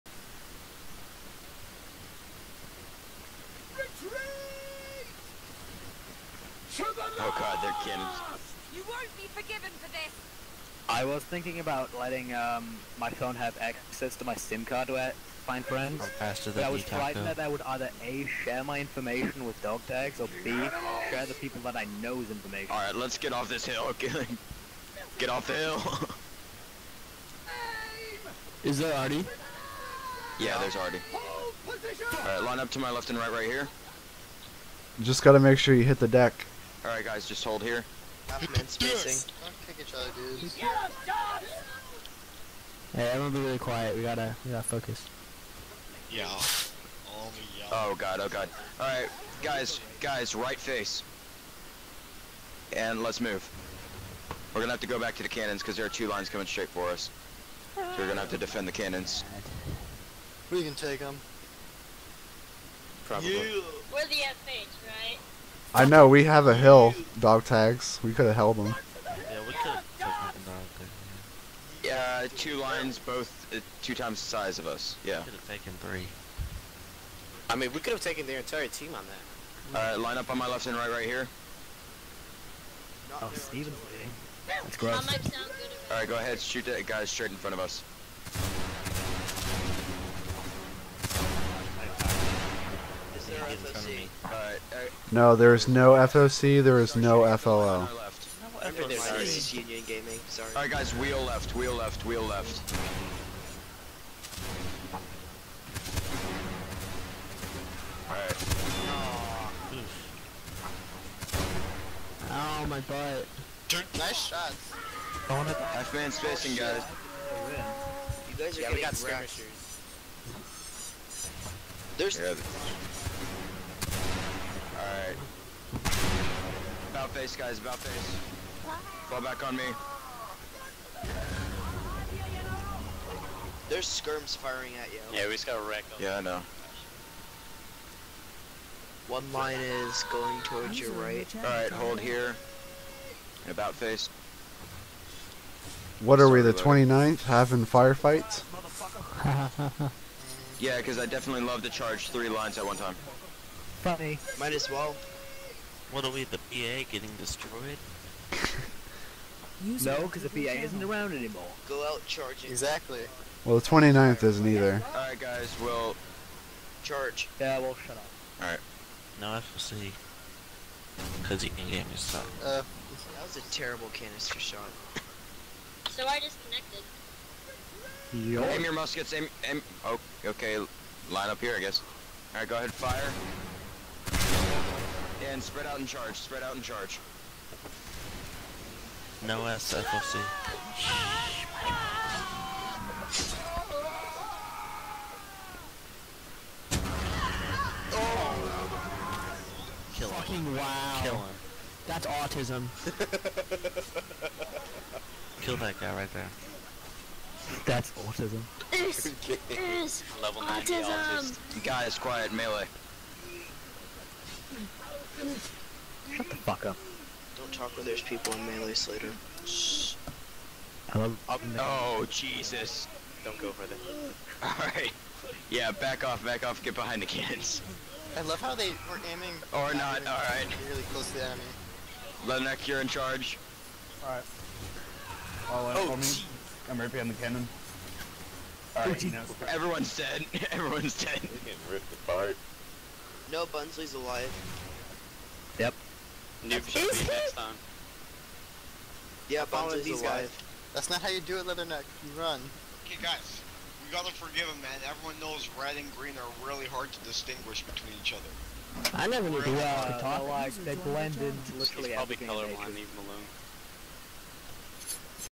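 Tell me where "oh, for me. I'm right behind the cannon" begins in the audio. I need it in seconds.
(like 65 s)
235 s.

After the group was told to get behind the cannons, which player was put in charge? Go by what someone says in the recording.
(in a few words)
Lenek.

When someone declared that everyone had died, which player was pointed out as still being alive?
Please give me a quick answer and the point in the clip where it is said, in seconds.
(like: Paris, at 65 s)
Bunsley, at 243 s.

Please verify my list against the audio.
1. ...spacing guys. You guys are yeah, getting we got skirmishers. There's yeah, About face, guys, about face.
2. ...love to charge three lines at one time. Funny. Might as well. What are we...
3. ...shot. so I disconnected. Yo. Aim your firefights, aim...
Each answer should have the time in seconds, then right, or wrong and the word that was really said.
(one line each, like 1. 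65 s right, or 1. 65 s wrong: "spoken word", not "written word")
1. 116 s right
2. 151 s right
3. 174 s wrong: "muskets", not "firefights".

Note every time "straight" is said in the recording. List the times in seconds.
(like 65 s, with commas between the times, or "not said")
56 s, 87 s.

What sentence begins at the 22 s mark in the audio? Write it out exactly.
Alright, let's get off this hill.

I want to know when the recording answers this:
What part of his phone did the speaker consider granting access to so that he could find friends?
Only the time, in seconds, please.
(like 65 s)
14 s.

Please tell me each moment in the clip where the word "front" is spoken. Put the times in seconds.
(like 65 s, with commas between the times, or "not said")
87 s, 93 s.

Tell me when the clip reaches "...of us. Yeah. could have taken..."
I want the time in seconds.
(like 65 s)
74 s.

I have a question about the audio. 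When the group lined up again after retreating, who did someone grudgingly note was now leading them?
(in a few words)
Steven.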